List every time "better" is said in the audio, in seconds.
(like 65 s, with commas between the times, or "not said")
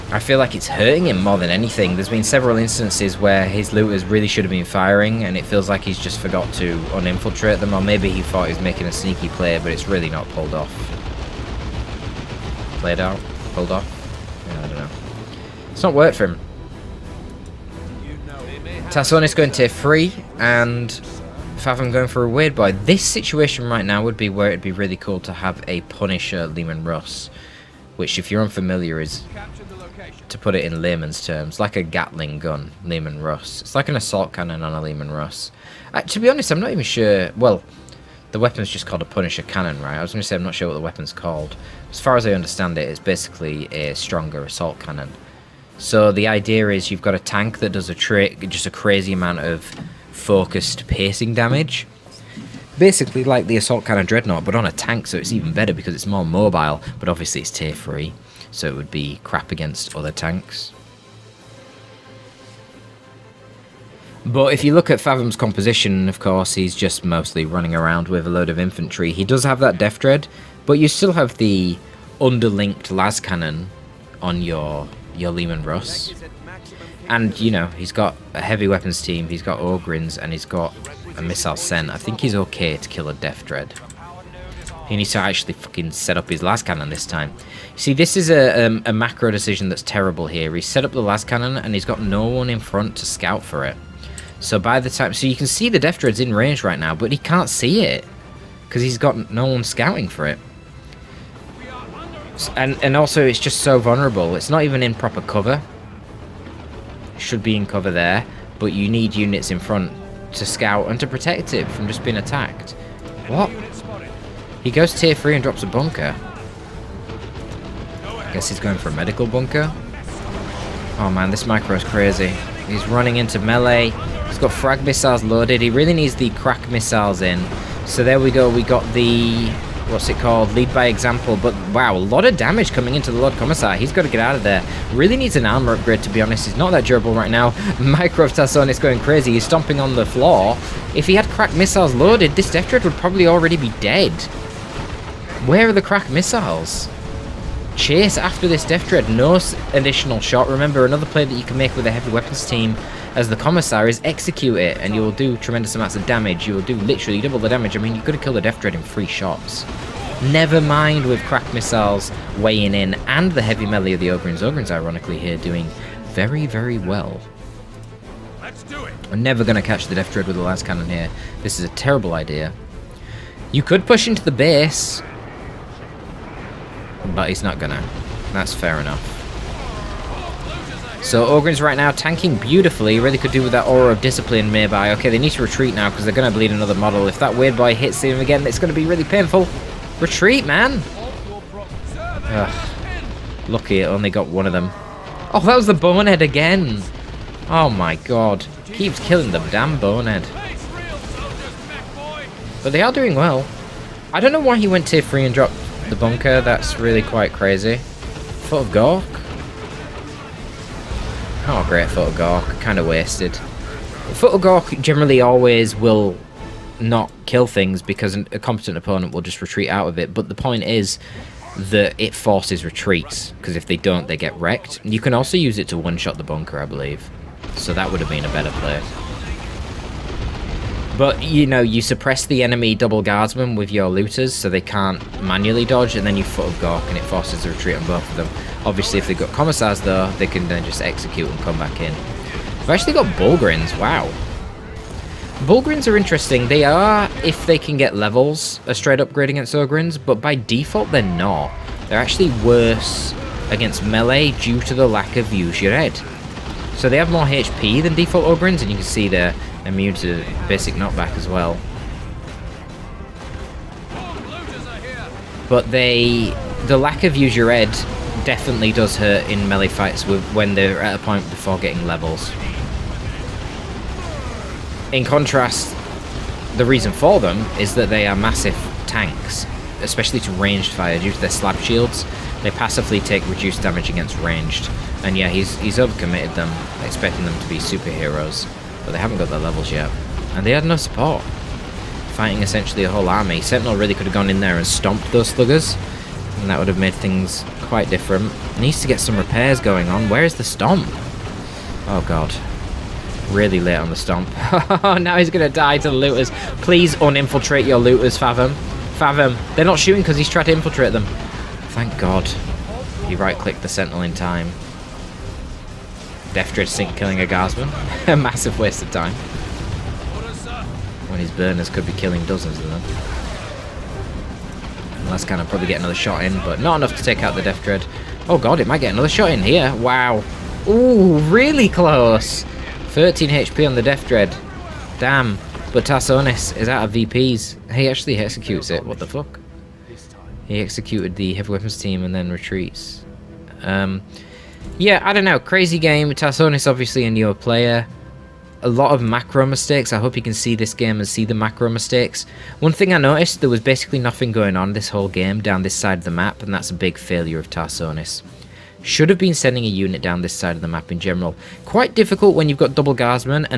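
55 s, 228 s.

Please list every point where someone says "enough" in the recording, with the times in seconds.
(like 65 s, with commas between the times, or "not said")
178 s, 326 s.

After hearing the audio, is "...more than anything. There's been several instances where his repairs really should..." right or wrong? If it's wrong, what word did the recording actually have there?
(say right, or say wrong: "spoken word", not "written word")
wrong: "looters", not "repairs".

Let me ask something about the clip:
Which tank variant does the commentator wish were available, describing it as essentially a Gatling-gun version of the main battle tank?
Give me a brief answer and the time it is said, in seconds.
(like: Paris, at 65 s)
Punisher Leman Russ, at 25 s.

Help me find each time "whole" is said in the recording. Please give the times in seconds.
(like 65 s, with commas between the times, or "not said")
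292 s, 354 s.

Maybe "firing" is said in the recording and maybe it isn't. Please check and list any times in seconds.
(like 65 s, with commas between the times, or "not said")
4 s.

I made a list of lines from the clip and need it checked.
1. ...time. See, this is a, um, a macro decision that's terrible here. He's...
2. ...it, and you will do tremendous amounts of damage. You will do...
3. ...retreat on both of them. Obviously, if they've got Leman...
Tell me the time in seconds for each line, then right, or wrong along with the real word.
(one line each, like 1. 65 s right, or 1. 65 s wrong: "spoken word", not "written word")
1. 87 s right
2. 154 s right
3. 237 s wrong: "Commissars", not "Leman".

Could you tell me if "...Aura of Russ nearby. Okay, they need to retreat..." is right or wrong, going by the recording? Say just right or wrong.
wrong.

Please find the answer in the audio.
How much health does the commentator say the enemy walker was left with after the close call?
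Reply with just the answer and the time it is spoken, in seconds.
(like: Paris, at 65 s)
13 HP, at 332 s.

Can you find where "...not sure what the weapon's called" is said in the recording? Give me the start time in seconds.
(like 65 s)
40 s.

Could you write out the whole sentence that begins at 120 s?
Oh man, this micro is crazy.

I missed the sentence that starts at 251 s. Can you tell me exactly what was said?
They're actually worse against melee due to the lack of use your head.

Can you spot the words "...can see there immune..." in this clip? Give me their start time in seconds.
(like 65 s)
258 s.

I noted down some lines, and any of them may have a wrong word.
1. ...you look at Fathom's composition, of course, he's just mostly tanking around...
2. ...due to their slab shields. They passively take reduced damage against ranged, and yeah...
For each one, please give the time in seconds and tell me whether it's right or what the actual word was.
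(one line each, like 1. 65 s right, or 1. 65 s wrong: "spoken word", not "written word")
1. 64 s wrong: "running", not "tanking"
2. 280 s right.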